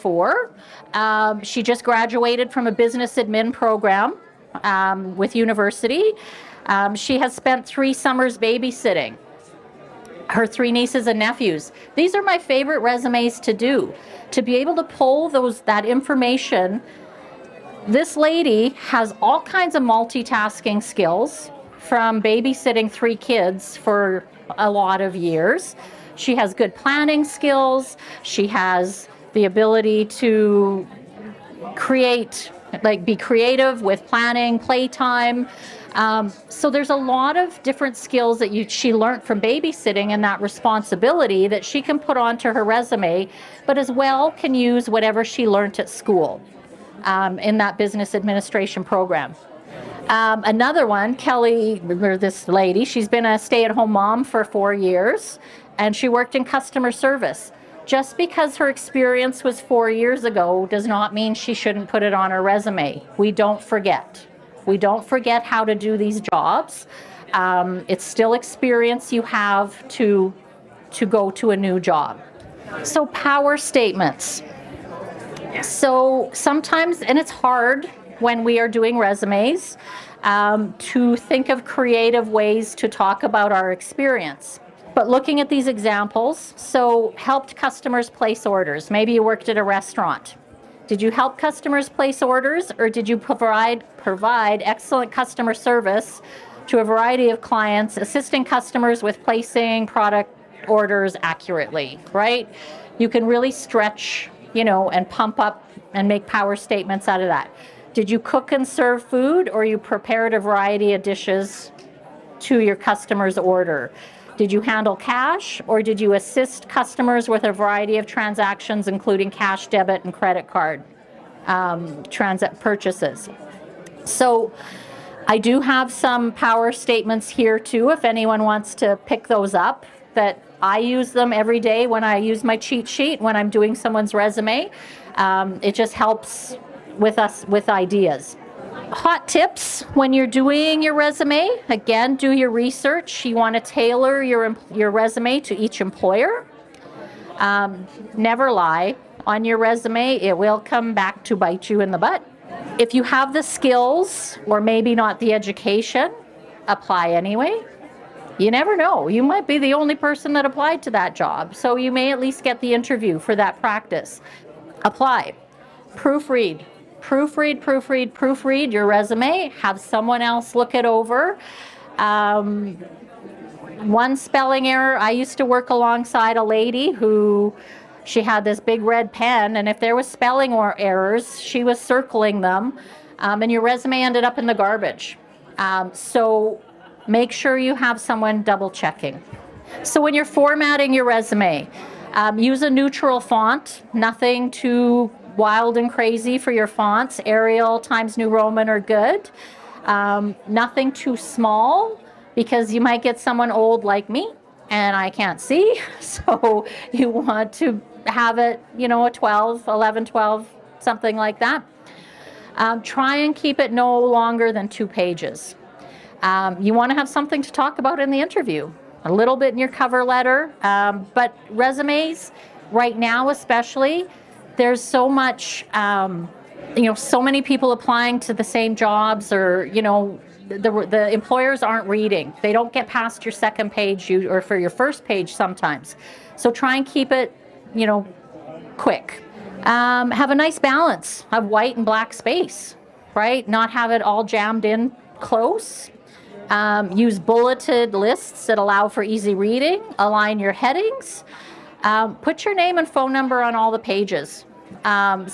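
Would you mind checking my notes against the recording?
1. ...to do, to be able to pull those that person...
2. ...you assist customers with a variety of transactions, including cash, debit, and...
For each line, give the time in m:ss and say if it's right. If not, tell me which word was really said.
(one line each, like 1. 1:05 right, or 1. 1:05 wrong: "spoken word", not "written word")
1. 0:13 wrong: "information", not "person"
2. 1:55 right.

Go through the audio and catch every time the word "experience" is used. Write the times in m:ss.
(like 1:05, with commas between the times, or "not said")
0:58, 1:08, 1:23.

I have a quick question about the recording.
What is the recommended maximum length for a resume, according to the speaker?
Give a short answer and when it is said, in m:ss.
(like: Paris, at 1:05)
2 pages, at 3:34.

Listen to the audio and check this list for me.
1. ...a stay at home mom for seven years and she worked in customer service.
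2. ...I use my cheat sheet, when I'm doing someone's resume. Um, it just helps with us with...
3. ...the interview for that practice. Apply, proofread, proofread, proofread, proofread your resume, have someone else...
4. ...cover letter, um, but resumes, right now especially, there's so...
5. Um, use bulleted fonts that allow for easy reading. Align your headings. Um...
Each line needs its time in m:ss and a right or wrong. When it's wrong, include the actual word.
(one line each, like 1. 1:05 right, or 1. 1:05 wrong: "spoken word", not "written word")
1. 0:53 wrong: "four", not "seven"
2. 2:12 right
3. 2:42 right
4. 3:39 right
5. 4:06 wrong: "lists", not "fonts".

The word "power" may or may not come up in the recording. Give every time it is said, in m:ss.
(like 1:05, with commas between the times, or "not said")
1:13, 1:46, 2:06.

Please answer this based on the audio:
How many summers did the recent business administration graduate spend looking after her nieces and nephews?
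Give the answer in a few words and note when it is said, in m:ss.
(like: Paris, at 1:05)
3, at 0:07.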